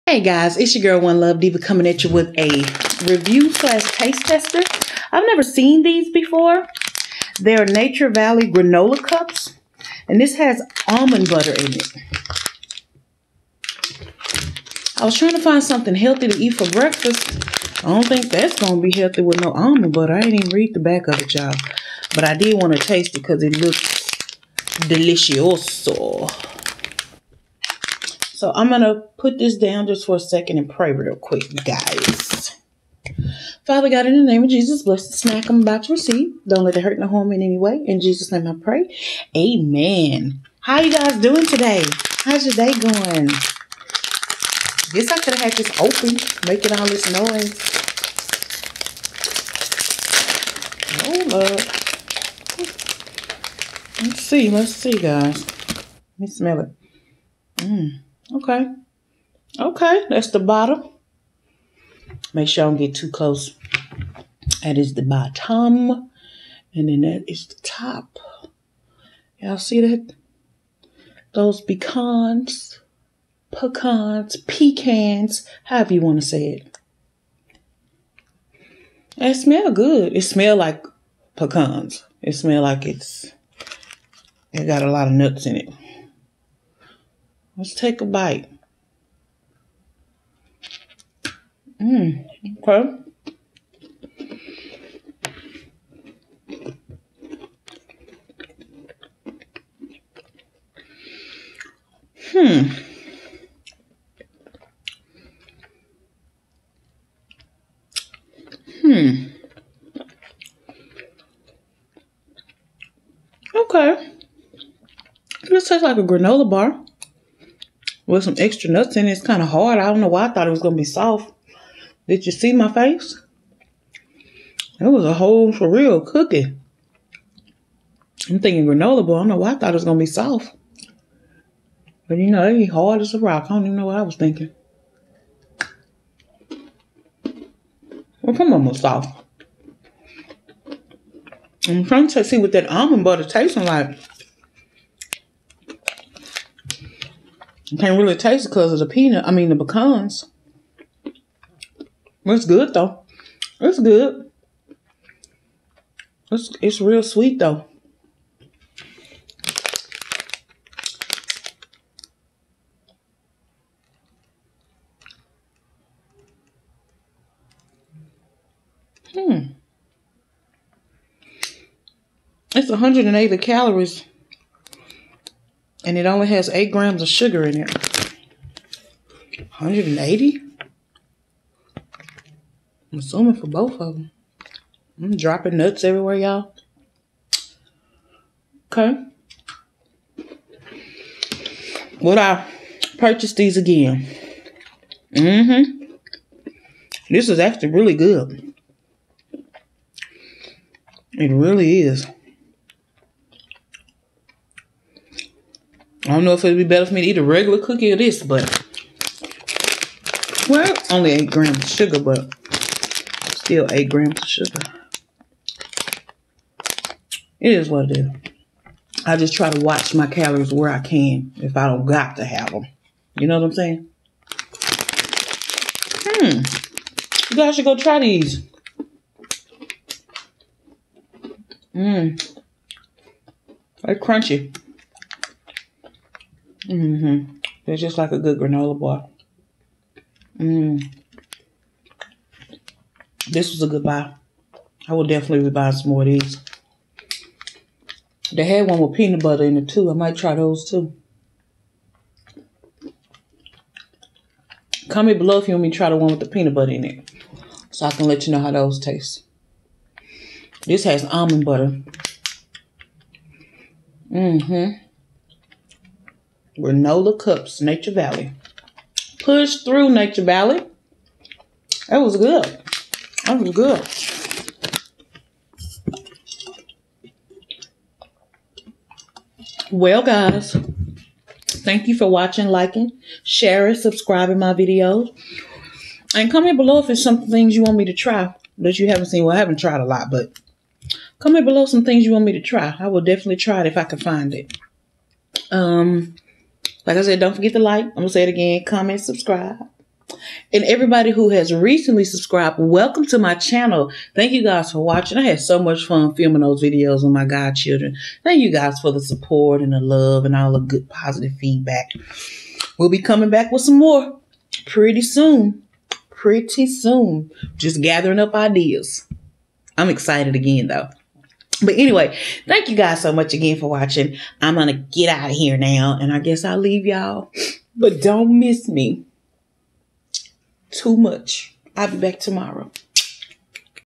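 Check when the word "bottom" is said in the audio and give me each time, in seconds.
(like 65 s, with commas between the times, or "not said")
60 s, 65 s.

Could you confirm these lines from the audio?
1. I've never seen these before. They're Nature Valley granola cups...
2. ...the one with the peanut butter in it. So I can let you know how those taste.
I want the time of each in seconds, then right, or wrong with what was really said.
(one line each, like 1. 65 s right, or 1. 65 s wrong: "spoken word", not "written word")
1. 5 s right
2. 255 s right.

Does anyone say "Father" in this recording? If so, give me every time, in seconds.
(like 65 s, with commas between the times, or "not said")
33 s.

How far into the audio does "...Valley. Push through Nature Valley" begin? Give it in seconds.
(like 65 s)
267 s.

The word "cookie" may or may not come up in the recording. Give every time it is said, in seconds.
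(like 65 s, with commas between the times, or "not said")
126 s, 207 s.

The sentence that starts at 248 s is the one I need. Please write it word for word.
They had one with peanut butter in it too.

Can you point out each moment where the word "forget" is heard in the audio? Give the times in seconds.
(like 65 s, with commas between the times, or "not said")
297 s.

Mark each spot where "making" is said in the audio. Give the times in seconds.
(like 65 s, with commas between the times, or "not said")
46 s.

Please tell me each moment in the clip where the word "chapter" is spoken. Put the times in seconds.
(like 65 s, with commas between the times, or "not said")
not said.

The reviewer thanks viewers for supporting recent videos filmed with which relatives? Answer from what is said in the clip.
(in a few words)
godchildren.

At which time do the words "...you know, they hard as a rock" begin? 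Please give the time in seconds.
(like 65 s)
132 s.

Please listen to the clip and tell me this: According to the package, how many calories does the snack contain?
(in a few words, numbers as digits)
180.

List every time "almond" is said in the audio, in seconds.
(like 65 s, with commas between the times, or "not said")
10 s, 19 s, 142 s, 261 s.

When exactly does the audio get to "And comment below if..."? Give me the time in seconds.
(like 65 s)
286 s.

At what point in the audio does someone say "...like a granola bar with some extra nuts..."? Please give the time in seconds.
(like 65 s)
115 s.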